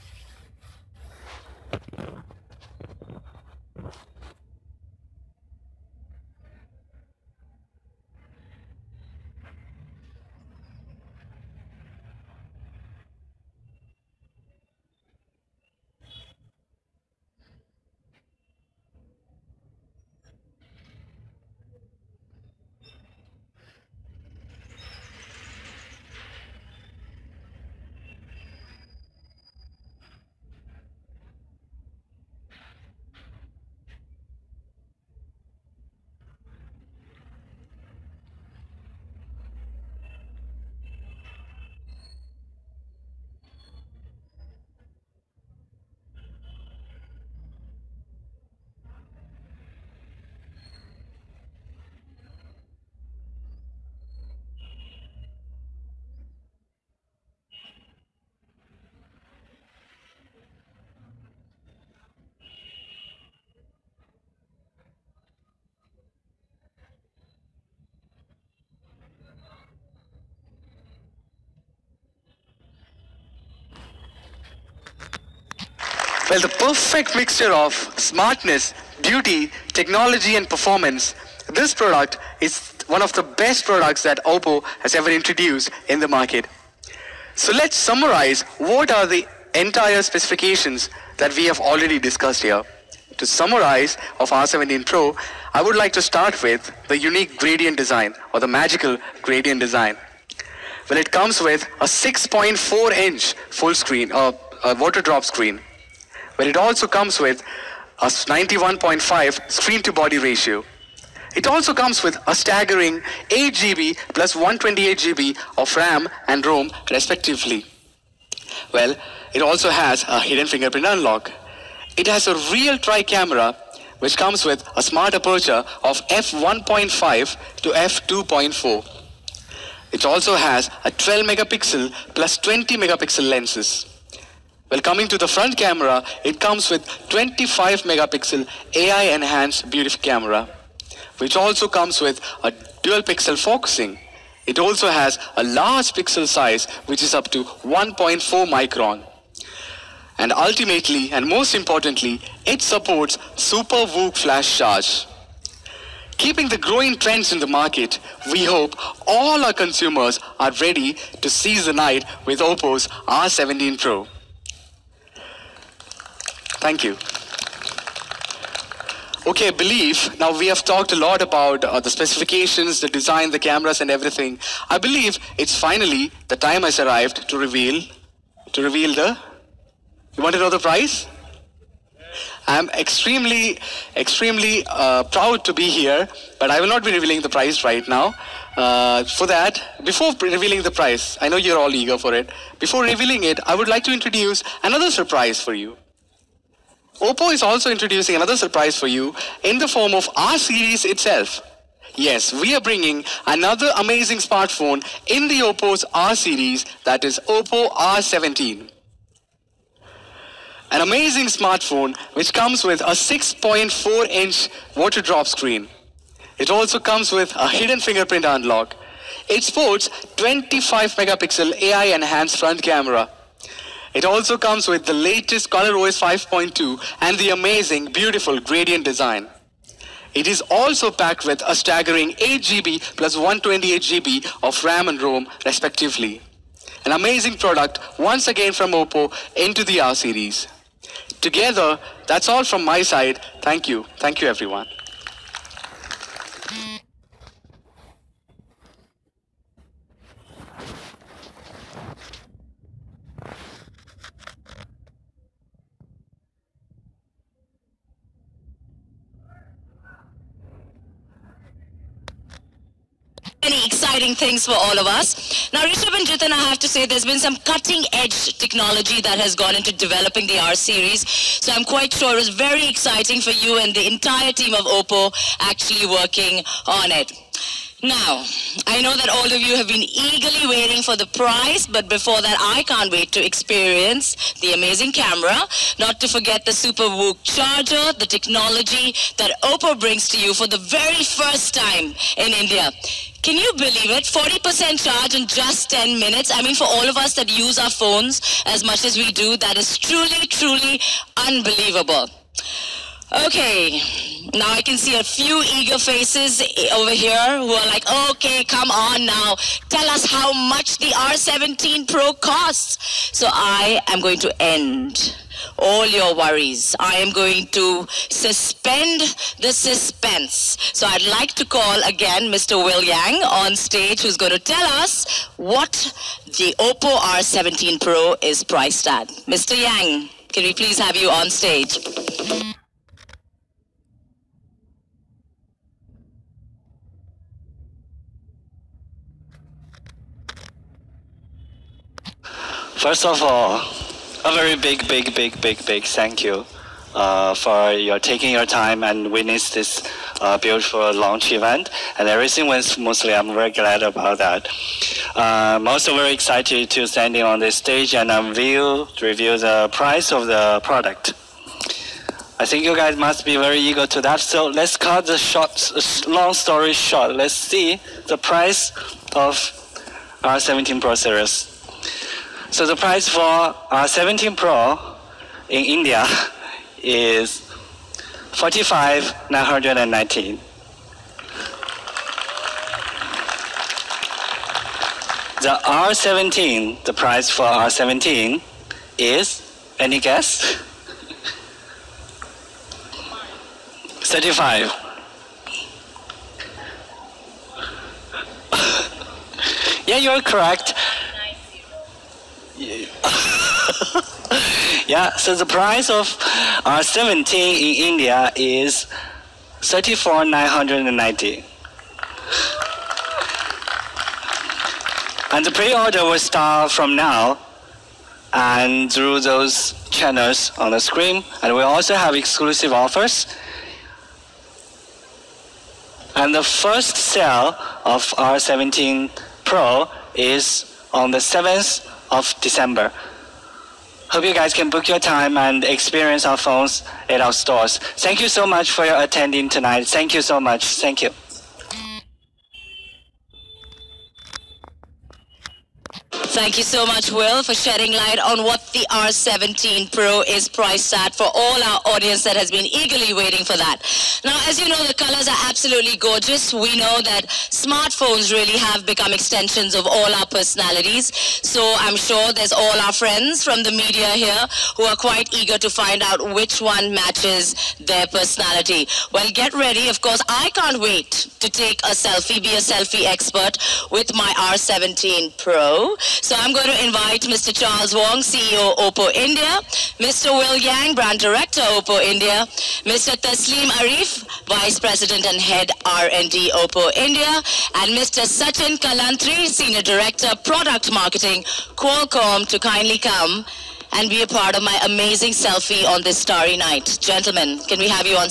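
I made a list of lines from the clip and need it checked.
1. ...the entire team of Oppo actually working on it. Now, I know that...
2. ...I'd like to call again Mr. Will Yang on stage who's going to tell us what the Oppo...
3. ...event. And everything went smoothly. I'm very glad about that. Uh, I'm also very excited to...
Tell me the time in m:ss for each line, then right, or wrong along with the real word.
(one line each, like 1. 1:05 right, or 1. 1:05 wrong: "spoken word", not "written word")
1. 4:33 right
2. 5:20 right
3. 5:51 right.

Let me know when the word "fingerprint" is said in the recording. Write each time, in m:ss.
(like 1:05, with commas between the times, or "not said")
2:00, 3:37.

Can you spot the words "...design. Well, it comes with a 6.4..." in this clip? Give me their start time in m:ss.
1:39.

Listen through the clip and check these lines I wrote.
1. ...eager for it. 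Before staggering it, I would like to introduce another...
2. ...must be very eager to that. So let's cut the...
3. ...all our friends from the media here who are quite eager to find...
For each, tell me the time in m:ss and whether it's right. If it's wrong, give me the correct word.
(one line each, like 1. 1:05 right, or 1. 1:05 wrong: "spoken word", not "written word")
1. 3:11 wrong: "revealing", not "staggering"
2. 6:02 right
3. 7:42 right.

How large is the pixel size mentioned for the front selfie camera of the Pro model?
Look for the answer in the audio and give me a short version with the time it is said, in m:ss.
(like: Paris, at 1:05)
1.4 micron, at 2:27.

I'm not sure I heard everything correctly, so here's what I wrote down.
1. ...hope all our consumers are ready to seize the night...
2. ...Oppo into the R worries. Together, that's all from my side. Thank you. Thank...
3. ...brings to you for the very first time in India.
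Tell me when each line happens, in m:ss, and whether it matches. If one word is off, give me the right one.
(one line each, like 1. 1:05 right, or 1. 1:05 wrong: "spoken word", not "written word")
1. 2:38 right
2. 3:58 wrong: "series", not "worries"
3. 4:49 right.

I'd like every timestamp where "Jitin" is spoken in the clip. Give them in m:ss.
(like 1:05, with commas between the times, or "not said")
4:26.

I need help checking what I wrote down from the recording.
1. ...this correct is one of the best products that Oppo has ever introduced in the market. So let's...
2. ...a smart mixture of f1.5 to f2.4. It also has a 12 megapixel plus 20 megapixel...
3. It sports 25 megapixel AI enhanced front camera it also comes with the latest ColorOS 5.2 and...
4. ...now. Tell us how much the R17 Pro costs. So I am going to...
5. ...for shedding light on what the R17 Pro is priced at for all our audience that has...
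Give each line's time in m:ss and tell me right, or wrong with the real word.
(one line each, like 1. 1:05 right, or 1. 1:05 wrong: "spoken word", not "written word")
1. 1:21 wrong: "product", not "correct"
2. 2:04 wrong: "aperture", not "mixture"
3. 3:39 right
4. 5:09 right
5. 7:27 right.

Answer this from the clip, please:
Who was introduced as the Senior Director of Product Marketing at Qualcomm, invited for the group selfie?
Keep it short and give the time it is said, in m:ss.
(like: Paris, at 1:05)
Sachin Kalantri, at 8:08.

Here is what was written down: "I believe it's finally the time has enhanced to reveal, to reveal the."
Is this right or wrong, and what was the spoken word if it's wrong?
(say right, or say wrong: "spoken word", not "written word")
wrong: "arrived", not "enhanced".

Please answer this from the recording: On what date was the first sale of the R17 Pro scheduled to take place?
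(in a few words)
7th of December.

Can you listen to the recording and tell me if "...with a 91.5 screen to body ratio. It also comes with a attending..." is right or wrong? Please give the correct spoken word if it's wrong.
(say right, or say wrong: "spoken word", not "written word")
wrong: "staggering", not "attending".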